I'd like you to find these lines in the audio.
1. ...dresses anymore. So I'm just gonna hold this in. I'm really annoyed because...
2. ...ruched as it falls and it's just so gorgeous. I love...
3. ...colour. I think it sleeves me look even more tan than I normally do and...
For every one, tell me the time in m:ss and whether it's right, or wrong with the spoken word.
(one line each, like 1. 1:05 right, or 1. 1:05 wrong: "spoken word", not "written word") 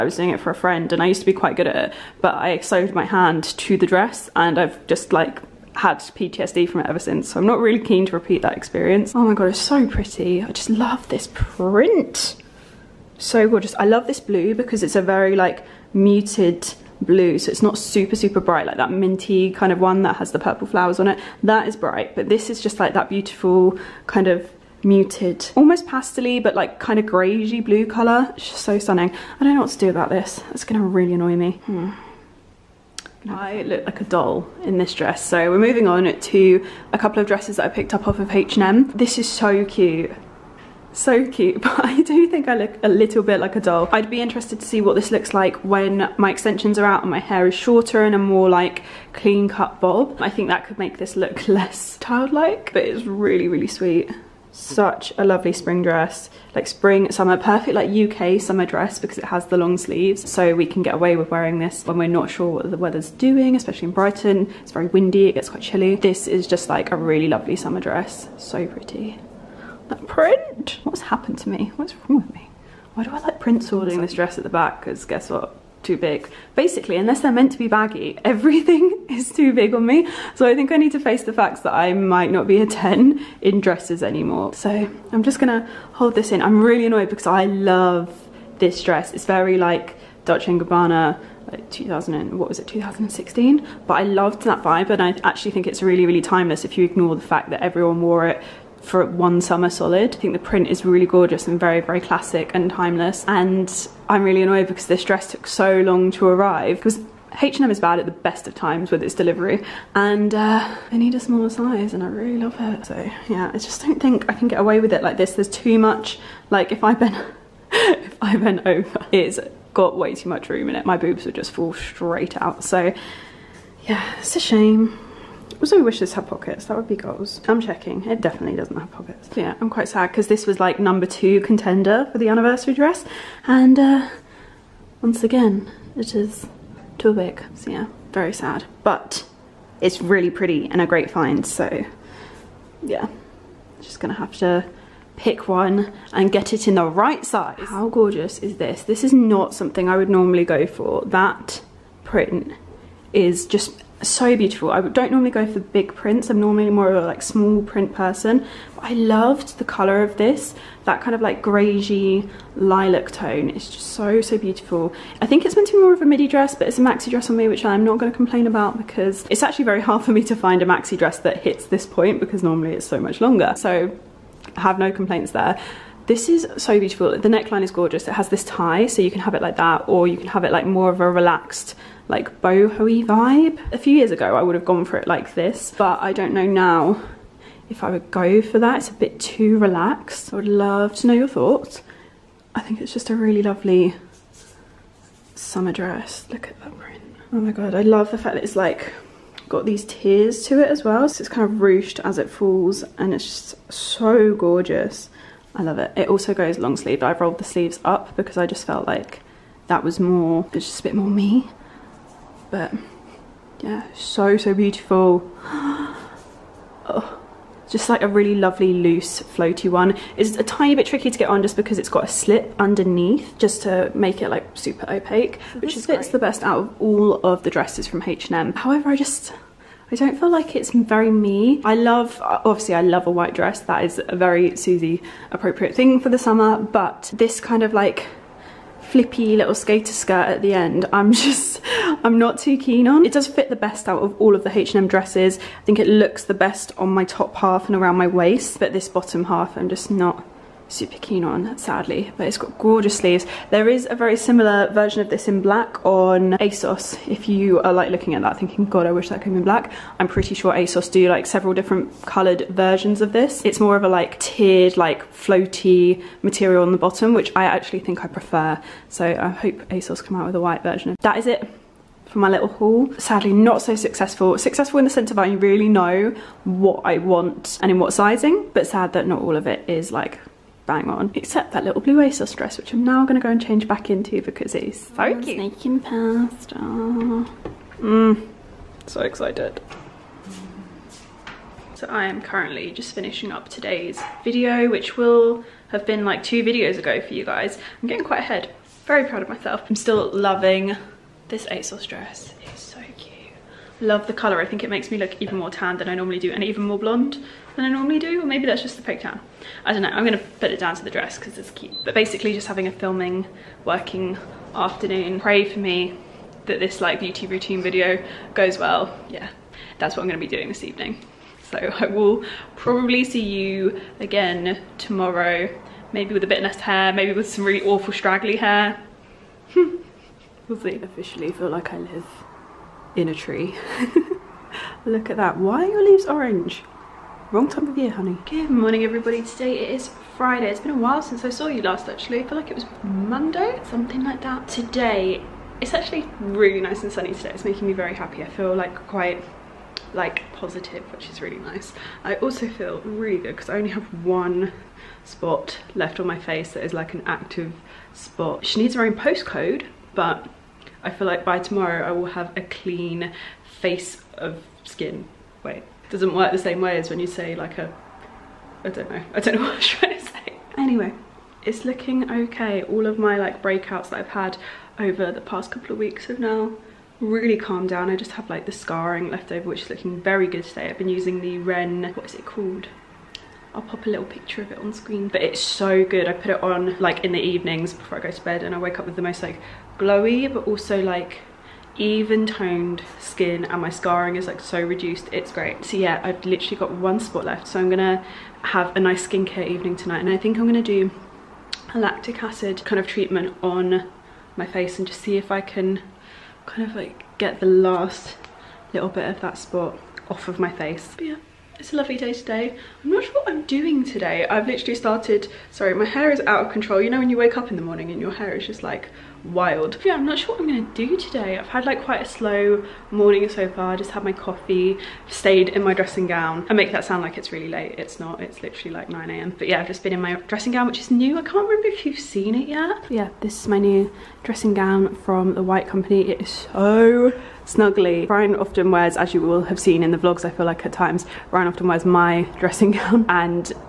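1. 1:23 right
2. 3:21 right
3. 5:04 wrong: "makes", not "sleeves".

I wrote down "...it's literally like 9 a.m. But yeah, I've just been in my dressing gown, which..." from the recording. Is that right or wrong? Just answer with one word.
right.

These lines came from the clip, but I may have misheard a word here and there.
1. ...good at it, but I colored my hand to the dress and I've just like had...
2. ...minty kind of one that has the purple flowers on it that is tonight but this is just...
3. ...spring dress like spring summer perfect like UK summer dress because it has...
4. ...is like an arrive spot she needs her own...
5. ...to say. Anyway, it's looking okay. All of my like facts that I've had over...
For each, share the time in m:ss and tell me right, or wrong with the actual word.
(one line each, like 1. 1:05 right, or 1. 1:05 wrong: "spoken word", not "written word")
1. 0:01 wrong: "sewed", not "colored"
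2. 0:18 wrong: "bright", not "tonight"
3. 0:55 right
4. 5:56 wrong: "active", not "arrive"
5. 6:09 wrong: "breakouts", not "facts".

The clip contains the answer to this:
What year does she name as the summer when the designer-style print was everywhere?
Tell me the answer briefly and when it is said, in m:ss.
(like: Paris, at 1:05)
2016, at 1:32.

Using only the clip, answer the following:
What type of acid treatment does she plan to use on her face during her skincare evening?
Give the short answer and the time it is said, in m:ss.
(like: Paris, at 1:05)
lactic acid, at 6:41.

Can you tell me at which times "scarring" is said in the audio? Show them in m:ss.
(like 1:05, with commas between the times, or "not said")
6:18, 6:33.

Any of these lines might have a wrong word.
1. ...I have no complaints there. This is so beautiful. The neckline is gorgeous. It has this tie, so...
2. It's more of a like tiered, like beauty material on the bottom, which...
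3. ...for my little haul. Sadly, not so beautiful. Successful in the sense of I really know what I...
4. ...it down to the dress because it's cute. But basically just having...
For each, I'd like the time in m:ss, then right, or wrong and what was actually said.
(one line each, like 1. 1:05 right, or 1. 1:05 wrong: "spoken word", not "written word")
1. 2:54 right
2. 4:23 wrong: "floaty", not "beauty"
3. 4:32 wrong: "successful", not "beautiful"
4. 5:10 right.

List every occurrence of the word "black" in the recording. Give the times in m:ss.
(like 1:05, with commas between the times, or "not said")
4:15, 4:19.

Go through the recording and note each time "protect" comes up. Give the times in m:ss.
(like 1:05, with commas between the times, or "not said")
not said.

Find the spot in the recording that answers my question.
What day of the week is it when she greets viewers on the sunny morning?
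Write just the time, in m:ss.
5:40.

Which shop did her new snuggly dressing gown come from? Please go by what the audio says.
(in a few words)
The White Company.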